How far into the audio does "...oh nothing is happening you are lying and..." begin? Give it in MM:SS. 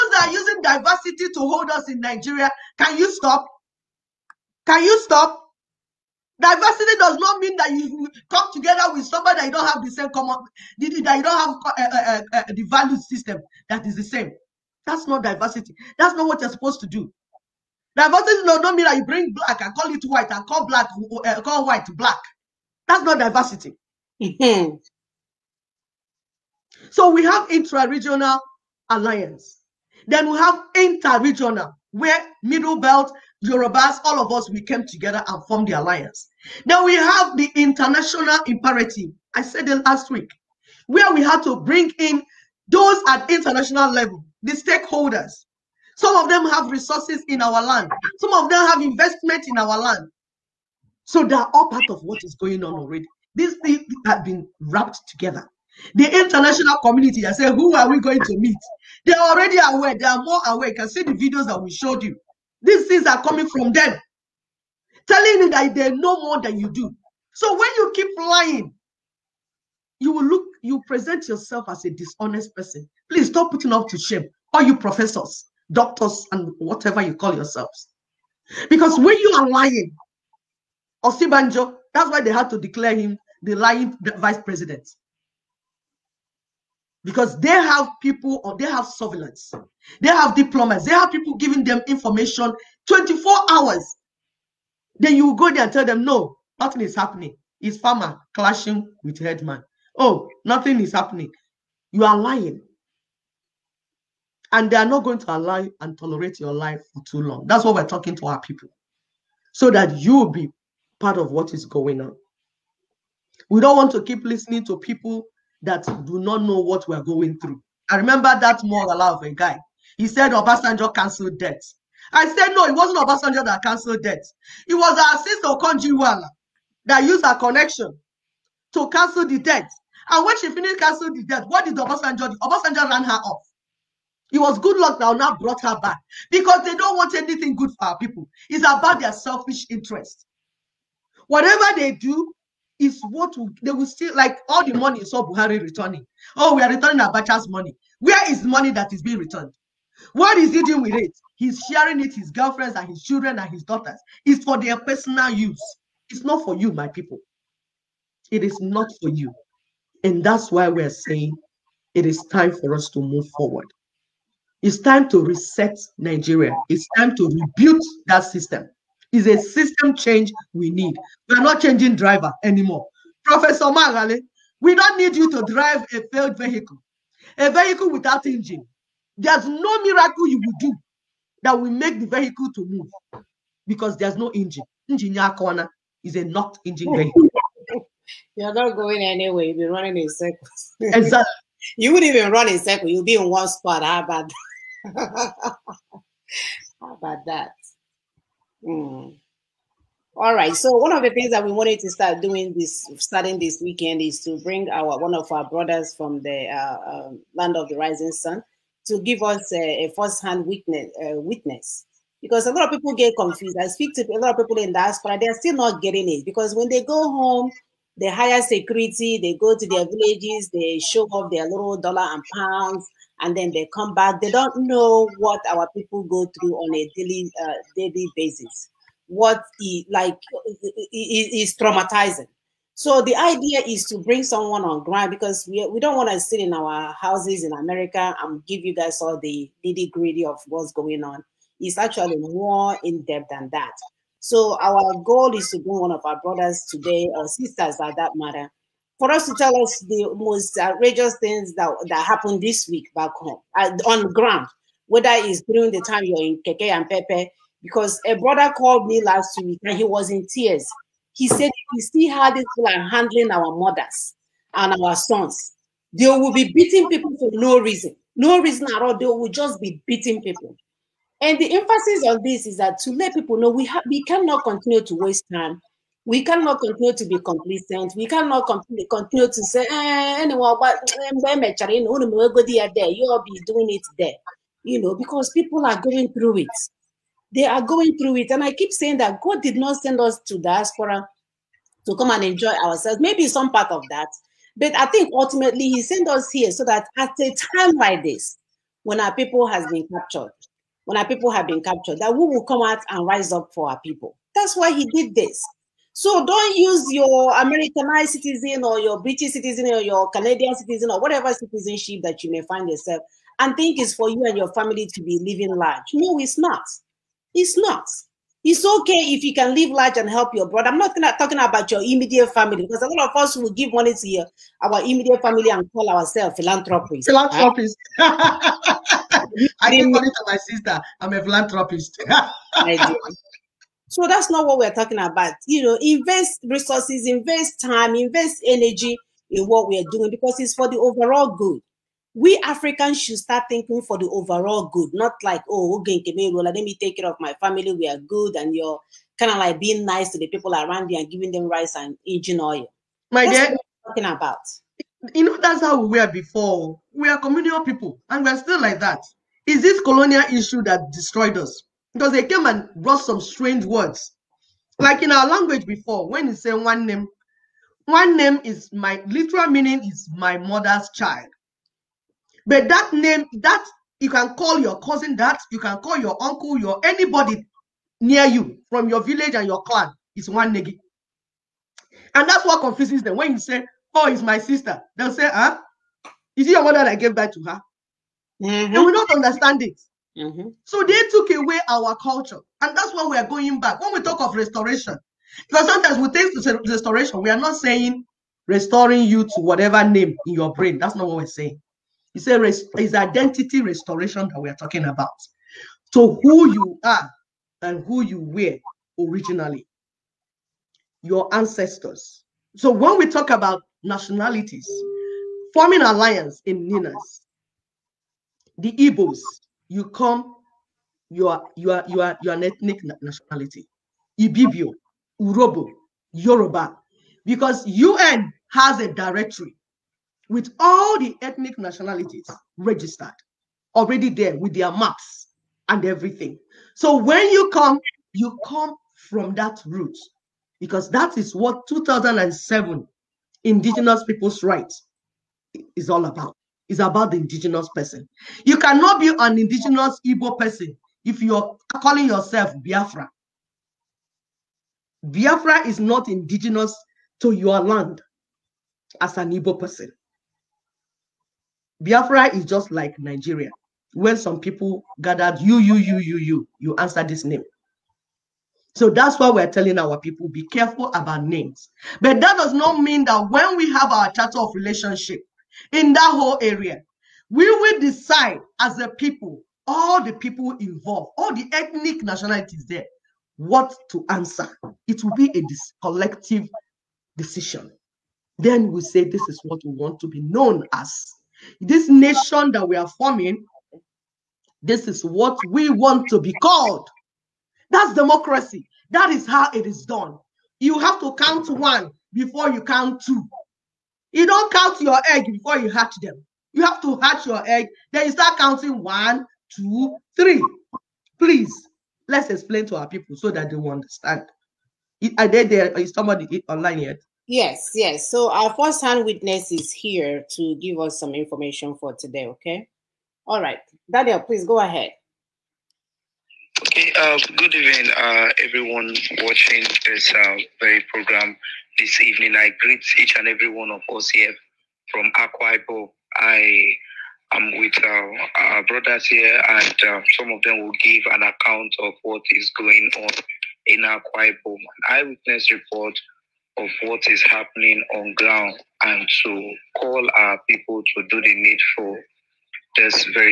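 01:39.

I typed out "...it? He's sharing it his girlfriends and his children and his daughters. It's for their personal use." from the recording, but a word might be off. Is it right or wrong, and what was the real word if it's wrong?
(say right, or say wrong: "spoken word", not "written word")
right.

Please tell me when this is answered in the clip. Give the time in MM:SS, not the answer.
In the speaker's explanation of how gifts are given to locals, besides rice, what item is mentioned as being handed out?
05:52.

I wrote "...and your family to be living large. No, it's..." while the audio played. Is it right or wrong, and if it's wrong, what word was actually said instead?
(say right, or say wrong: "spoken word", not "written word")
right.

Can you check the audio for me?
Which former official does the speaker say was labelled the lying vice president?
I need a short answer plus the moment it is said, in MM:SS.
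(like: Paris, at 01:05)
Osinbajo, at 01:21.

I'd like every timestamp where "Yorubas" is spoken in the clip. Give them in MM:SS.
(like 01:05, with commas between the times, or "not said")
00:33, 07:06.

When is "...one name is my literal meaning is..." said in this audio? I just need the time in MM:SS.
06:07.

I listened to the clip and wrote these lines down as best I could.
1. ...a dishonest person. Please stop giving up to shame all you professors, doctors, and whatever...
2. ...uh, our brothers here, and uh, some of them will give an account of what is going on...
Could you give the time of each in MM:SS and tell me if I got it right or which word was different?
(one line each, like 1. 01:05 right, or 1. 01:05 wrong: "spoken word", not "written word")
1. 01:11 wrong: "putting", not "giving"
2. 08:58 right.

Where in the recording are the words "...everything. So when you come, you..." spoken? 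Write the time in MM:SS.
07:15.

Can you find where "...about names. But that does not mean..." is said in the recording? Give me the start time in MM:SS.
07:50.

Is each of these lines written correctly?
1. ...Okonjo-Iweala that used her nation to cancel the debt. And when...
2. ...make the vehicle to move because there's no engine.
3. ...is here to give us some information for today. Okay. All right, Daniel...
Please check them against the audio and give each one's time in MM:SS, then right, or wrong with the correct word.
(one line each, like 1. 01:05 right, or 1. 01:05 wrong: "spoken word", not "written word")
1. 02:05 wrong: "connection", not "nation"
2. 03:01 right
3. 08:39 right.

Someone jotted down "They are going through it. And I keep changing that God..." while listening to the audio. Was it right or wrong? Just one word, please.
wrong.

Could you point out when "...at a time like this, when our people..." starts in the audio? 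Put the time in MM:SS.
04:56.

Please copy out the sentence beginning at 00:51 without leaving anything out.
So they are all part of what is going on already.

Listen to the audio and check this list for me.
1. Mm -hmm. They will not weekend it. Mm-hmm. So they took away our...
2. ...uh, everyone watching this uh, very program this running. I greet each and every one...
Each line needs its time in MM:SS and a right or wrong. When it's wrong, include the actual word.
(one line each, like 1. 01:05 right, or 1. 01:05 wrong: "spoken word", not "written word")
1. 06:28 wrong: "understand", not "weekend"
2. 08:47 wrong: "evening", not "running".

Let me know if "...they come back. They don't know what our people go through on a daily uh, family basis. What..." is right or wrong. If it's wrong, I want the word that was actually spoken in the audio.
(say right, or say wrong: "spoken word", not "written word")
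wrong: "daily", not "family".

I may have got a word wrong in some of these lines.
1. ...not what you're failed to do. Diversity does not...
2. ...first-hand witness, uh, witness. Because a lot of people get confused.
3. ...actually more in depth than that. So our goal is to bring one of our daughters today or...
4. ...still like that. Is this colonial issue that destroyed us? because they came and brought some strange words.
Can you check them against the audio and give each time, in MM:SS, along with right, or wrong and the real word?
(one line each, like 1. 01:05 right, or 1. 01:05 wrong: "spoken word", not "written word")
1. 00:16 wrong: "supposed", not "failed"
2. 03:29 right
3. 04:01 wrong: "brothers", not "daughters"
4. 05:58 right.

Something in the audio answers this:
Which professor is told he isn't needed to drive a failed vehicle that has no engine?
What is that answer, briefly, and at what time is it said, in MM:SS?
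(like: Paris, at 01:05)
Moghalu, at 02:53.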